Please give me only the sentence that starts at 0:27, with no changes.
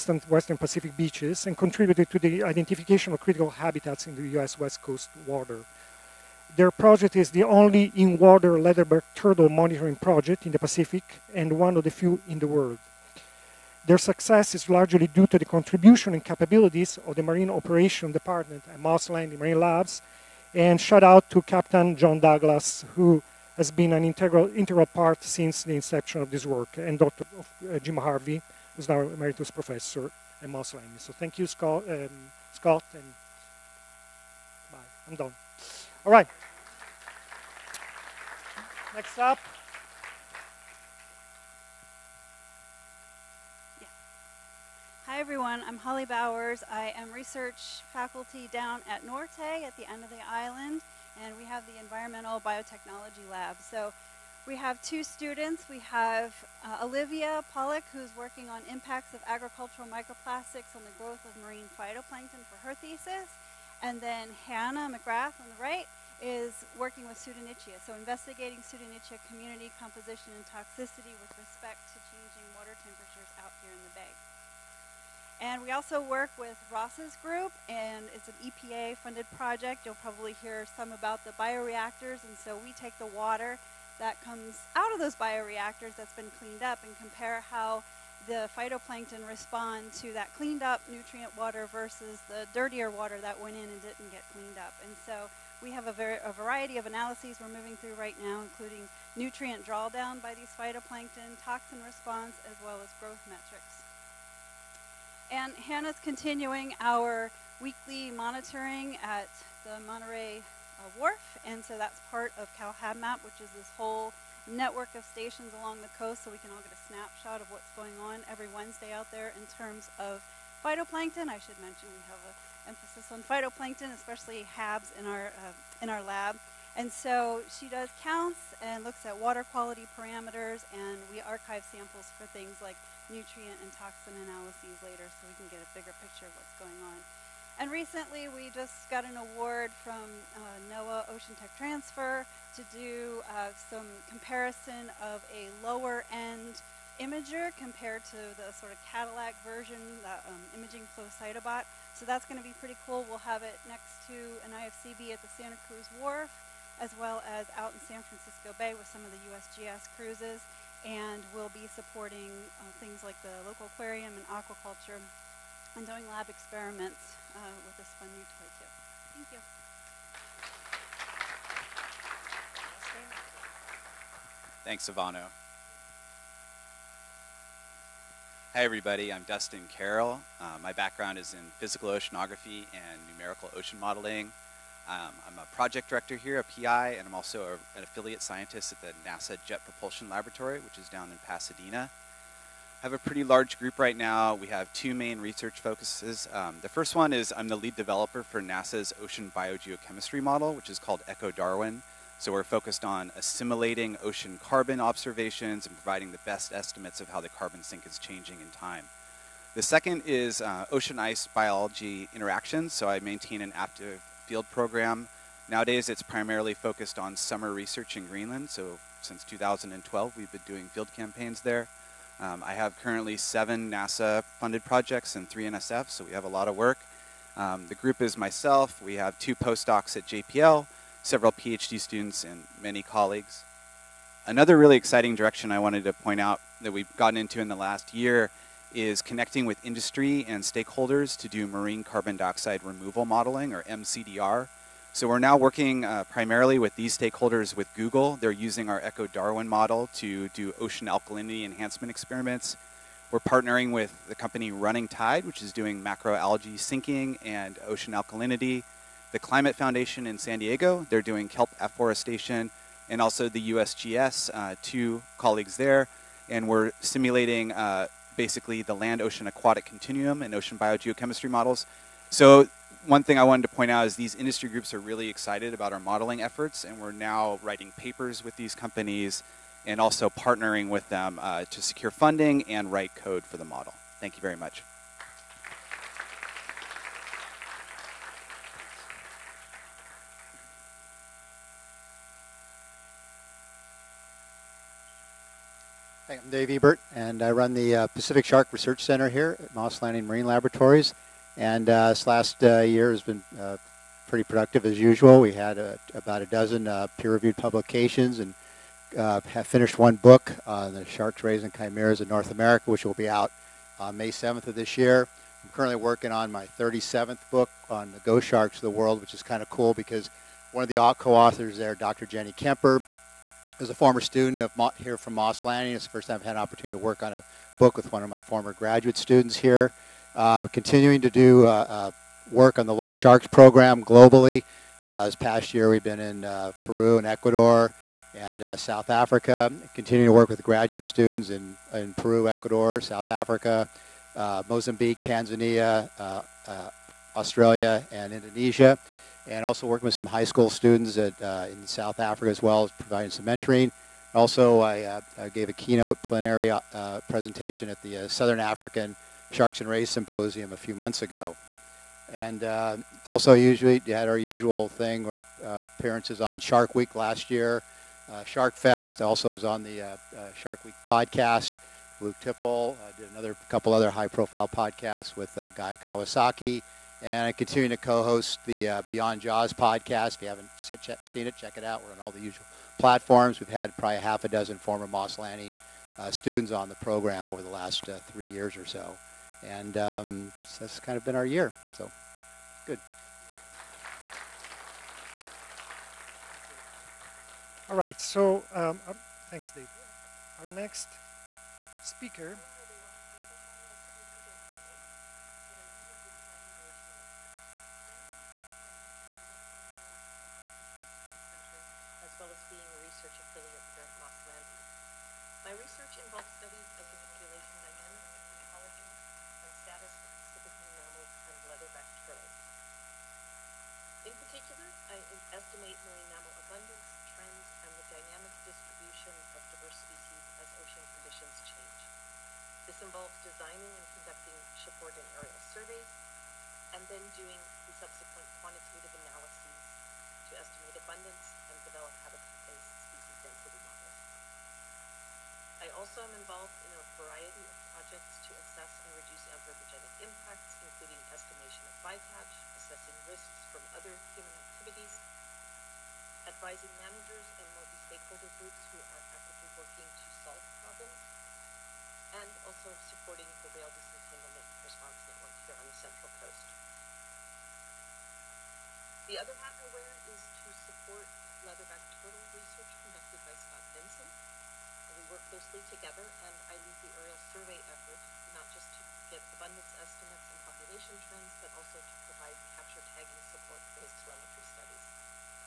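Uh, Jim Harvey, who's now Emeritus Professor at Moss Landing.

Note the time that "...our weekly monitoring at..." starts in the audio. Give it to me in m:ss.
1:46.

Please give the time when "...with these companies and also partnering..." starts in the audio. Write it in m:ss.
4:38.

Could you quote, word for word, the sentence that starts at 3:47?
Um, the group is myself, we have two postdocs at JPL, several PhD students and many colleagues.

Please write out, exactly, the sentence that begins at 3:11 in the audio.
I have a pretty large group right now.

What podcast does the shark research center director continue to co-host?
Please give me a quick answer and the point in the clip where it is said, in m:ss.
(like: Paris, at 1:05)
Beyond Jaws, at 6:18.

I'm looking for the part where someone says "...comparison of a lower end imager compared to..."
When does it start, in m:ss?
2:24.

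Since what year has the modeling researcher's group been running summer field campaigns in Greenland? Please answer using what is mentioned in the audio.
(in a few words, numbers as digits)
2012.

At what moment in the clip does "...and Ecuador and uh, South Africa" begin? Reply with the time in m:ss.
5:36.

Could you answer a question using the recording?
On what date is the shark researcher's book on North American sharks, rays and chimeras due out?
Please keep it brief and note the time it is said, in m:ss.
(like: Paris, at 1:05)
May 7th, at 5:13.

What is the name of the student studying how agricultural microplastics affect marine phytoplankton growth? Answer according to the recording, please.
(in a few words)
Olivia Pollock.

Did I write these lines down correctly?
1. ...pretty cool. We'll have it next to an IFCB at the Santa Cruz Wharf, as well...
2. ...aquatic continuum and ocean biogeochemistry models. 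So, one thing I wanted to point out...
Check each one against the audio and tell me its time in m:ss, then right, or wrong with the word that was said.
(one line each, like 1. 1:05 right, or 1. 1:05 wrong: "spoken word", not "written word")
1. 2:32 right
2. 4:29 right.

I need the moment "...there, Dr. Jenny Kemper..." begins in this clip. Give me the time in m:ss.
5:21.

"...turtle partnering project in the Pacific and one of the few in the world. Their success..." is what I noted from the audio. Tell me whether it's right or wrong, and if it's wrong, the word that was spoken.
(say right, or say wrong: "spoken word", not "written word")
wrong: "monitoring", not "partnering".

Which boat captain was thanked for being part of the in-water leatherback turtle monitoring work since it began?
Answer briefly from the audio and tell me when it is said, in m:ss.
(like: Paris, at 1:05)
John Douglas, at 0:21.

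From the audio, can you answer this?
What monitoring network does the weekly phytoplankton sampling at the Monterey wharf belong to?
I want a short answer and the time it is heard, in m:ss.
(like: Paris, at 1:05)
CalHABMAP, at 1:52.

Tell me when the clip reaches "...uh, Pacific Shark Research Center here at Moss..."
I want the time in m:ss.
4:57.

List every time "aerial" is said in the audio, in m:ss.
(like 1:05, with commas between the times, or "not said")
7:15, 7:56.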